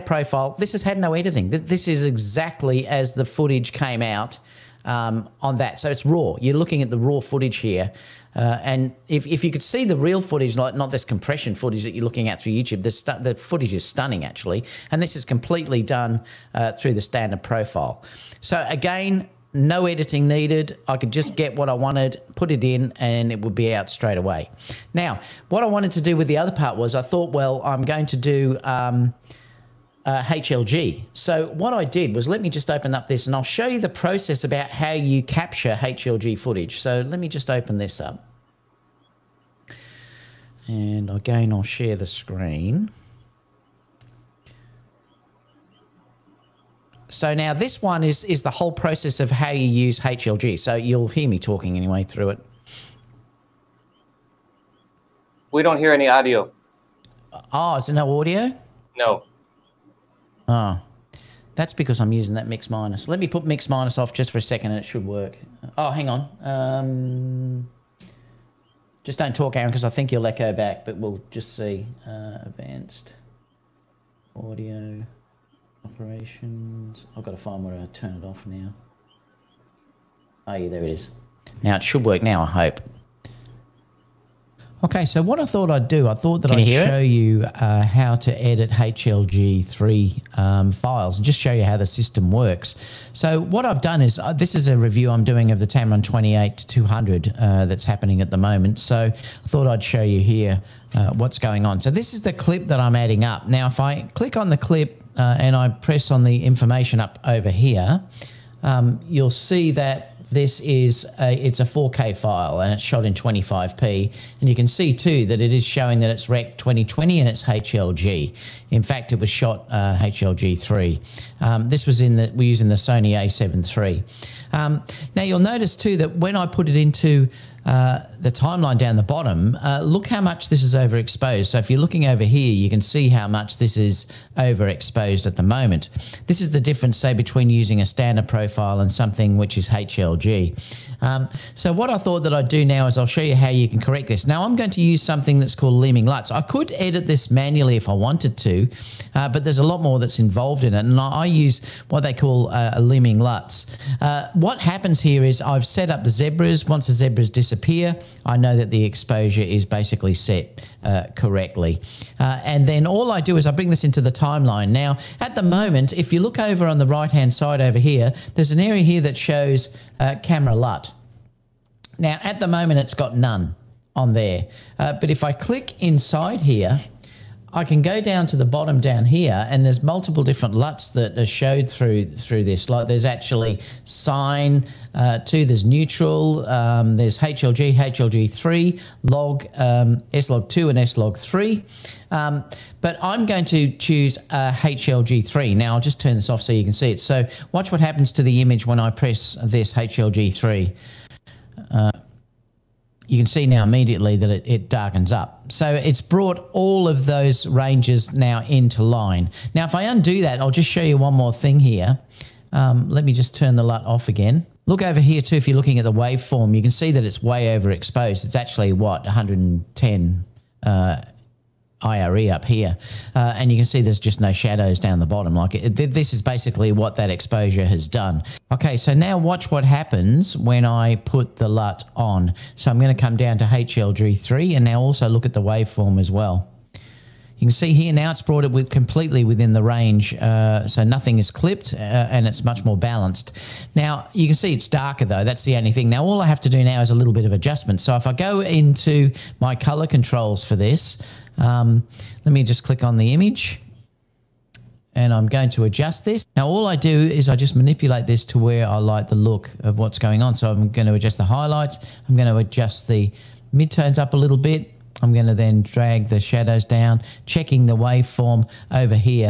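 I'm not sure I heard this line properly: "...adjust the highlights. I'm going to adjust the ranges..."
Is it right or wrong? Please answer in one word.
wrong.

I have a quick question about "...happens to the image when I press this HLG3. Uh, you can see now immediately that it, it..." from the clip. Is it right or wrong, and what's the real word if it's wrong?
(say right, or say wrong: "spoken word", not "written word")
right.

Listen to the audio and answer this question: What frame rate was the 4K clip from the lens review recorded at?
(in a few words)
25p.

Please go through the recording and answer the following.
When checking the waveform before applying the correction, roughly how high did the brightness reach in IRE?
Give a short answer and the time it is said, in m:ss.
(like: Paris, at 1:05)
110, at 3:39.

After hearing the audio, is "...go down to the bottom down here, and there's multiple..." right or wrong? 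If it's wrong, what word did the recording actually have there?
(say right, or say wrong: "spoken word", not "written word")
right.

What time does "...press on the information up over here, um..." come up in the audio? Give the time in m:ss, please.
1:45.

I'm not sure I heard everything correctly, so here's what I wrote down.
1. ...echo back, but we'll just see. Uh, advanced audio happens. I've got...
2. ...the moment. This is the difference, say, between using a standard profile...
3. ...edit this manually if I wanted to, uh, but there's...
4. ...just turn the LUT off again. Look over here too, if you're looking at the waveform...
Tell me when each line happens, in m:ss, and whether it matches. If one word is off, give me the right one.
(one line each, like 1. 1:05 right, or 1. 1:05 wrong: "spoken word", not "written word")
1. 1:10 wrong: "operations", not "happens"
2. 2:15 right
3. 2:26 right
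4. 3:33 right.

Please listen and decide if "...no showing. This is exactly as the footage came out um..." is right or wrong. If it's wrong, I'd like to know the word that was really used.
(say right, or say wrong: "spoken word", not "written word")
wrong: "editing", not "showing".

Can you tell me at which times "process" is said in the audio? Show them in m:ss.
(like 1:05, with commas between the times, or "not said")
0:33, 0:48.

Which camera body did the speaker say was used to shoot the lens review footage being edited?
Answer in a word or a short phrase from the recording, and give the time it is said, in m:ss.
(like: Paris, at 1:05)
Sony A7 III, at 2:02.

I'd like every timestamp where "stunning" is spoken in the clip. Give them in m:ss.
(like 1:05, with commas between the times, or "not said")
0:13.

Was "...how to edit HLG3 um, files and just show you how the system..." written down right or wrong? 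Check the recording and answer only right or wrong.
right.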